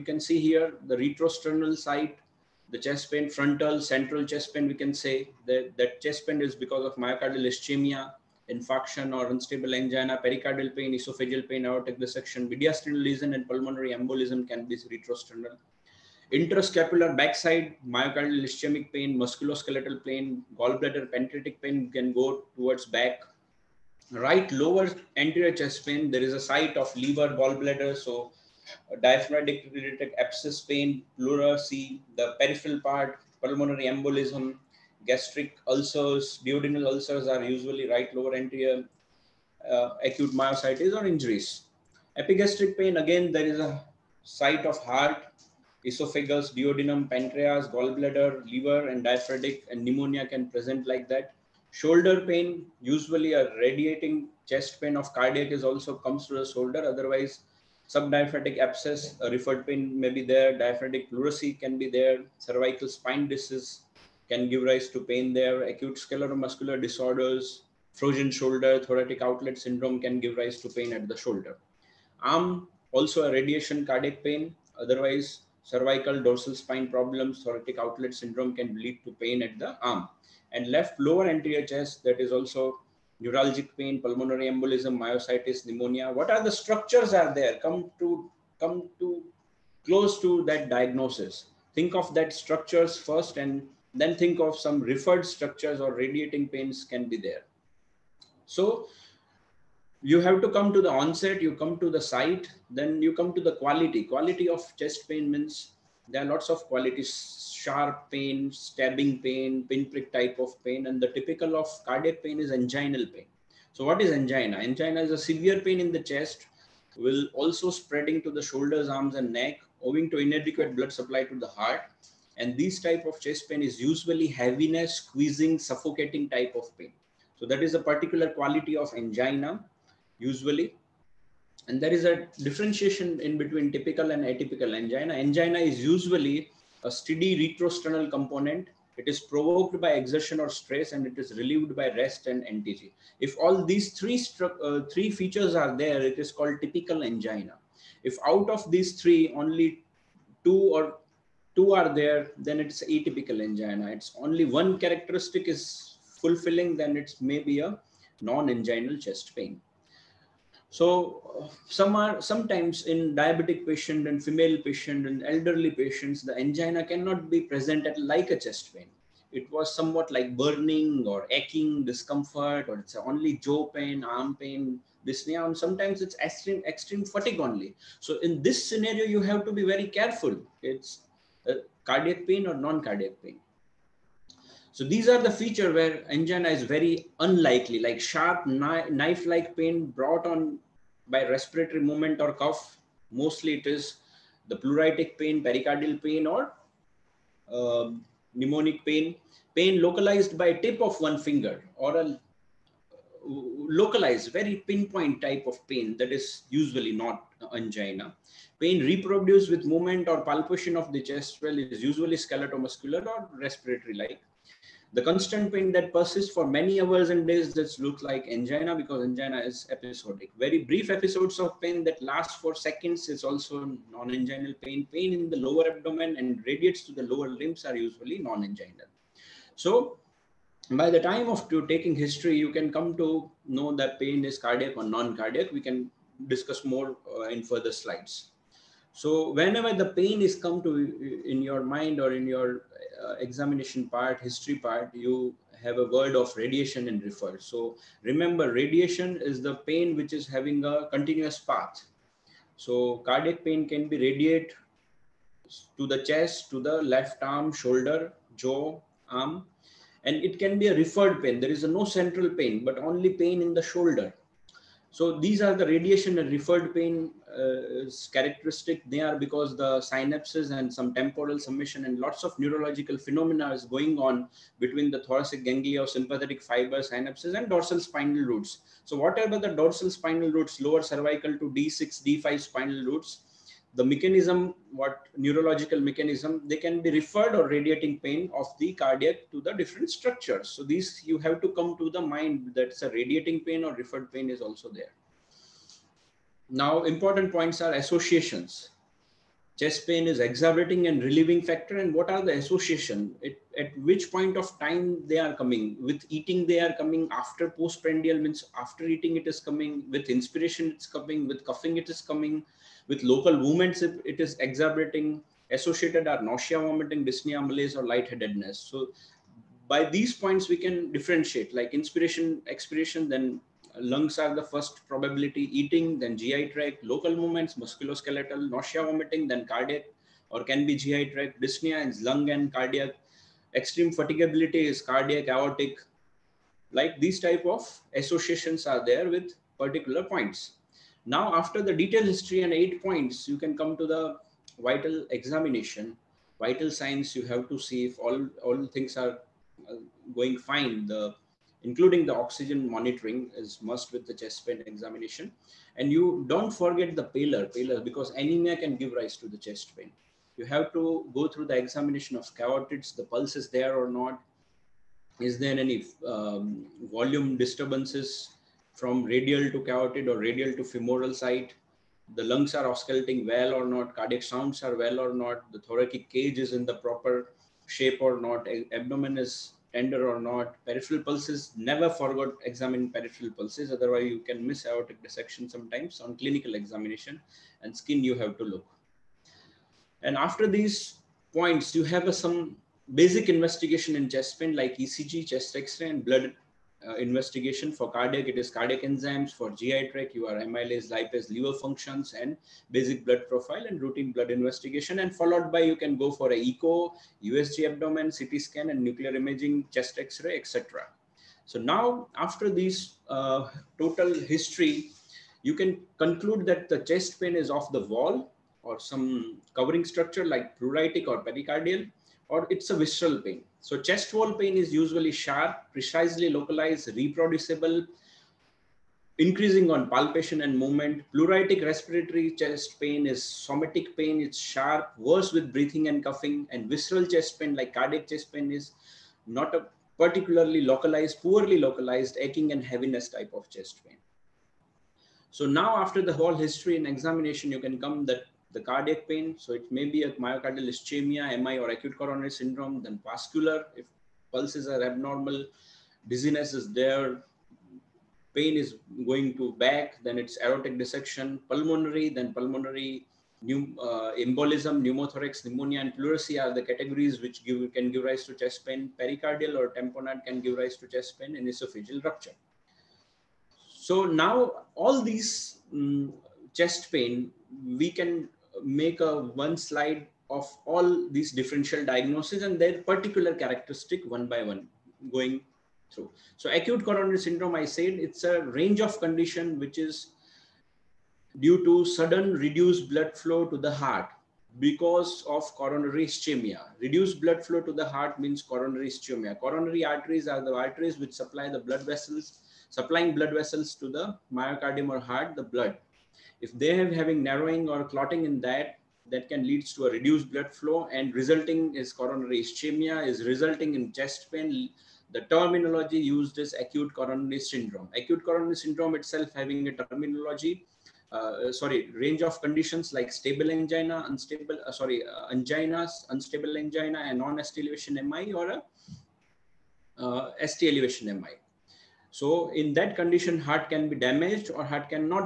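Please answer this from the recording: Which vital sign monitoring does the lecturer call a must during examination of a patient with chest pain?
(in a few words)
oxygen monitoring.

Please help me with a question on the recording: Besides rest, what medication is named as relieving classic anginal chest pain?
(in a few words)
NTG.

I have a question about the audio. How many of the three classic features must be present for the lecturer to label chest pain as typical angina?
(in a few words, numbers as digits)
3.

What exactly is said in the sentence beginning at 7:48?
Pericardial or tamponade can give rise to chest pain and esophageal rupture.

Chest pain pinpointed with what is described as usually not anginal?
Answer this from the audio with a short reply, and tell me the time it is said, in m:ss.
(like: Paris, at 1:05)
tip of one finger, at 3:20.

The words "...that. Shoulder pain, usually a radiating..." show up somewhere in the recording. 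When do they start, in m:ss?
0:51.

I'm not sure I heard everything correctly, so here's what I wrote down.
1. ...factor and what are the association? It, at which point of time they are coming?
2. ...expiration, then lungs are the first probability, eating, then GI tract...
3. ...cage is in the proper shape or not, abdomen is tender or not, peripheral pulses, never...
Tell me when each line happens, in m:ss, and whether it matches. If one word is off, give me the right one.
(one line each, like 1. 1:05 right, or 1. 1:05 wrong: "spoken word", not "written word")
1. 5:01 right
2. 5:22 right
3. 6:16 right.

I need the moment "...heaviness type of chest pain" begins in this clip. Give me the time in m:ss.
7:22.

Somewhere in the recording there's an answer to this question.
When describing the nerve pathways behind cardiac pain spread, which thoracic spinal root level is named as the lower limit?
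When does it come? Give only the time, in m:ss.
4:41.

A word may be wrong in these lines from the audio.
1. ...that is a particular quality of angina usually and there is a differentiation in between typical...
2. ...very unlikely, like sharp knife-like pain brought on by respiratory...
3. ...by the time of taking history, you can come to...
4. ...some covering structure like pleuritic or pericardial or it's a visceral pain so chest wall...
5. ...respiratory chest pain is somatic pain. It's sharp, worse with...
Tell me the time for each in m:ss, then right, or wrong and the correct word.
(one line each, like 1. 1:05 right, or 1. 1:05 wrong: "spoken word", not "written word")
1. 2:07 right
2. 3:06 right
3. 3:50 right
4. 6:58 right
5. 7:11 right.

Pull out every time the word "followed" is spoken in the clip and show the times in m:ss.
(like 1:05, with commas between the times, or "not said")
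6:45.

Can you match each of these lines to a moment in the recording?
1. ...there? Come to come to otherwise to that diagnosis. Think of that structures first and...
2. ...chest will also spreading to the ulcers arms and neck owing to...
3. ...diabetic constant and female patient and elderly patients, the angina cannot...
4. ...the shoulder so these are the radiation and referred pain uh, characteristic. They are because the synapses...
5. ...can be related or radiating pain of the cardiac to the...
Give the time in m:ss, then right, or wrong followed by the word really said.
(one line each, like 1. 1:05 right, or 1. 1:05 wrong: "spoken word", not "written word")
1. 1:27 wrong: "close", not "otherwise"
2. 1:56 wrong: "shoulders", not "ulcers"
3. 2:43 wrong: "patient", not "constant"
4. 4:23 right
5. 4:46 wrong: "referred", not "related".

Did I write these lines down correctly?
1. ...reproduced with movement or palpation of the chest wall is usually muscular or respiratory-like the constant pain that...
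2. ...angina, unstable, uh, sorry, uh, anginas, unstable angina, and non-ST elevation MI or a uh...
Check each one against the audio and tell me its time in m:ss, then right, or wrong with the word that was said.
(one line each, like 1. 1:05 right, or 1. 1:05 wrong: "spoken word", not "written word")
1. 3:28 right
2. 8:43 right.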